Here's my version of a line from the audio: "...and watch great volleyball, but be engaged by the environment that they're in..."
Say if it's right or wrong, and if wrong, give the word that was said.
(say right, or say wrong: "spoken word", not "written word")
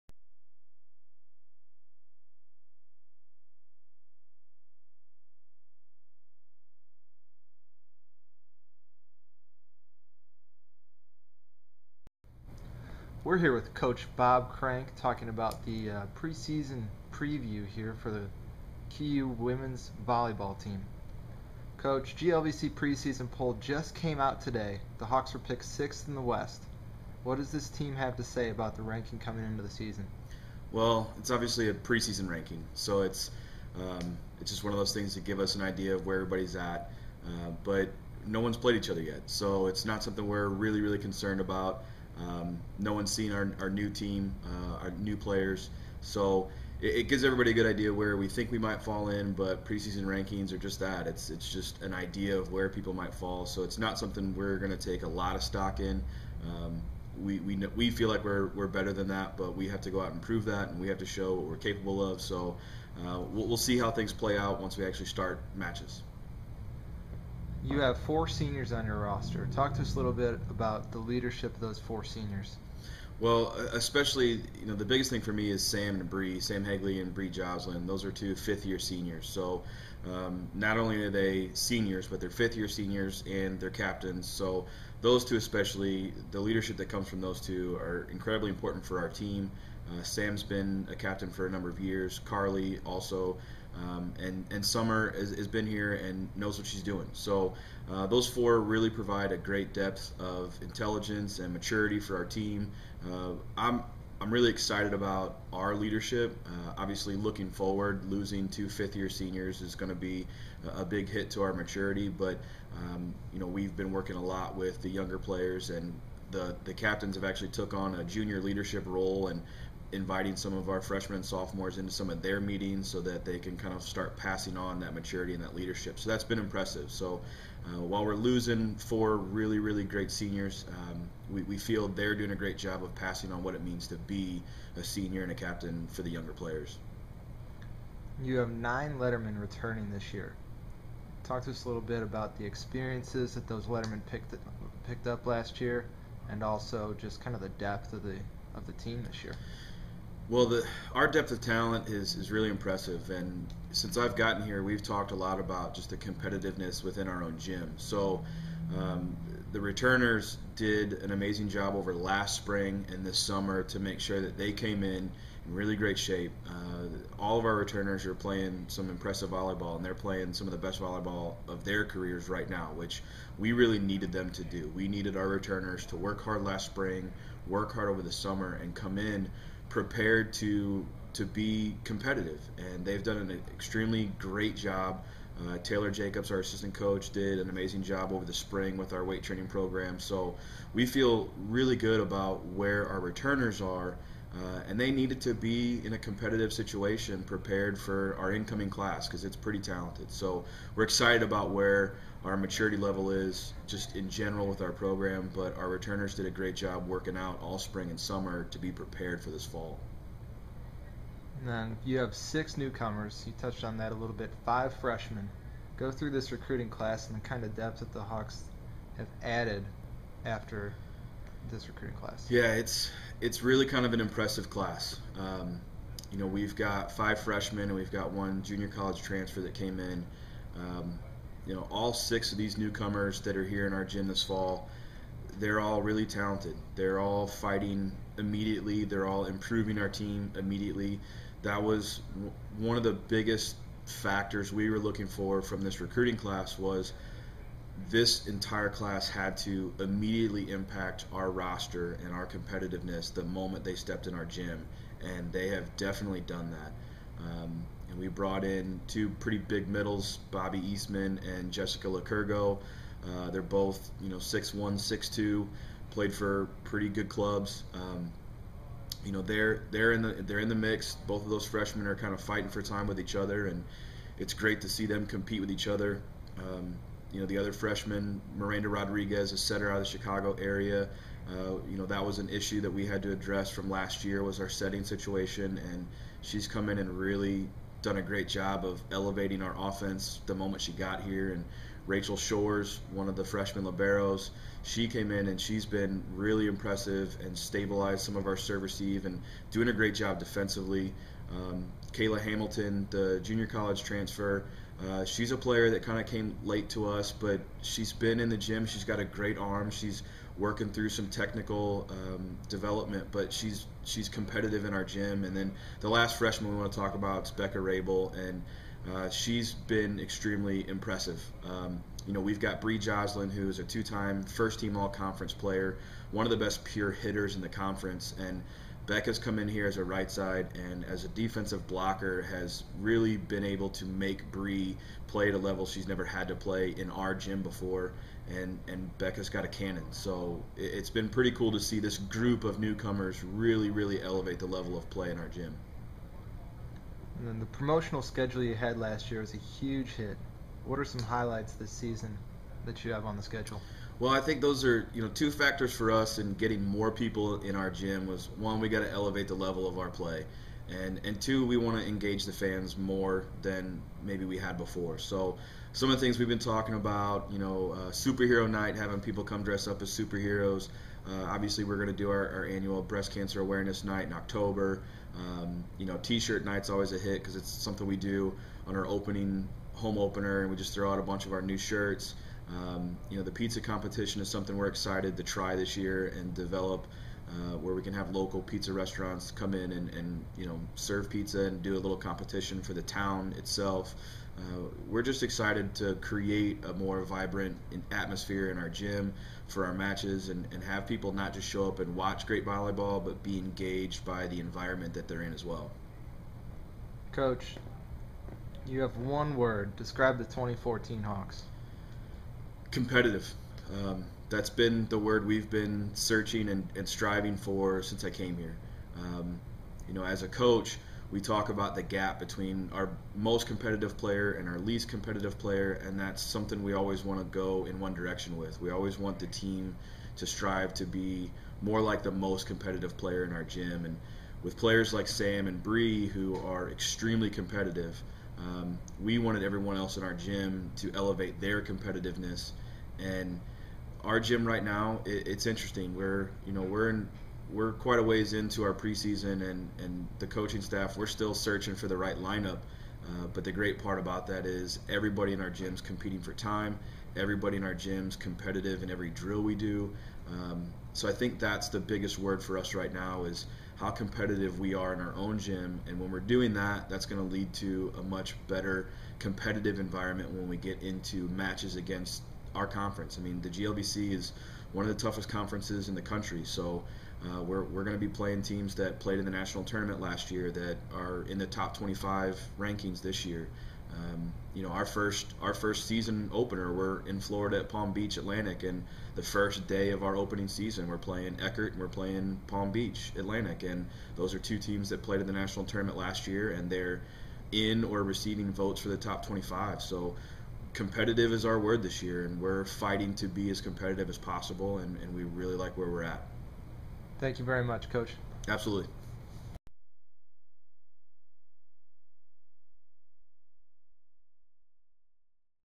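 right.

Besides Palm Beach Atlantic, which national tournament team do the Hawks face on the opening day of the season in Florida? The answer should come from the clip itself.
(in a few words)
Eckerd.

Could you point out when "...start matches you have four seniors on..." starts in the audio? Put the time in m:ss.
1:05.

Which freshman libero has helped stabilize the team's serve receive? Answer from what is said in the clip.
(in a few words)
Rachel Shores.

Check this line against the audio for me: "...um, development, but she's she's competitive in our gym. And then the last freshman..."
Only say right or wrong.
right.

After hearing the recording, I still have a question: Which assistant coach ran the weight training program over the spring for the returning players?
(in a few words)
Taylor Jacobs.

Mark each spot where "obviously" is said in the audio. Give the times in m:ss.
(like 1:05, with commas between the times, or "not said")
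0:31, 1:46, 6:11.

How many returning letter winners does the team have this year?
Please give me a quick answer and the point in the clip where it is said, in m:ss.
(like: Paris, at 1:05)
9, at 2:18.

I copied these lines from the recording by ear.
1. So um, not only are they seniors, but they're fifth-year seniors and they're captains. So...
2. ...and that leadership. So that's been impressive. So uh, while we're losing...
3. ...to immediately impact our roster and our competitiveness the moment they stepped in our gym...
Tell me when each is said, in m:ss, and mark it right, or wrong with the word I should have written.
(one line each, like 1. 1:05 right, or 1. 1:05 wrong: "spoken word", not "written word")
1. 1:19 right
2. 2:05 right
3. 4:09 right.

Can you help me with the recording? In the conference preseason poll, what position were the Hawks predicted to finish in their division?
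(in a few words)
Sixth.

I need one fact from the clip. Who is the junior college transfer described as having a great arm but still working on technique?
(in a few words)
Kayla Hamilton.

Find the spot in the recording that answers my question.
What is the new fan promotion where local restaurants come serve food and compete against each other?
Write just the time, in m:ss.
6:23.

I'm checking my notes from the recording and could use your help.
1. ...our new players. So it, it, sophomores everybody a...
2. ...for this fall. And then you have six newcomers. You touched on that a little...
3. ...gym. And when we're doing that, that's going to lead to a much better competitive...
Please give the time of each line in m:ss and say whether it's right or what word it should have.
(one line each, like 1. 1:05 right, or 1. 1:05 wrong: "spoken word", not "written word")
1. 0:44 wrong: "gives", not "sophomores"
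2. 3:29 right
3. 7:45 right.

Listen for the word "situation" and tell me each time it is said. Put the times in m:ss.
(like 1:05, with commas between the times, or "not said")
3:16, 4:44.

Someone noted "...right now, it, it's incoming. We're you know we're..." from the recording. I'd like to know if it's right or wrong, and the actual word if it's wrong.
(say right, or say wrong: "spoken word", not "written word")
wrong: "interesting", not "incoming".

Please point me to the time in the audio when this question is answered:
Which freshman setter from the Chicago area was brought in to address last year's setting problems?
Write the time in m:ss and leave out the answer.
4:38.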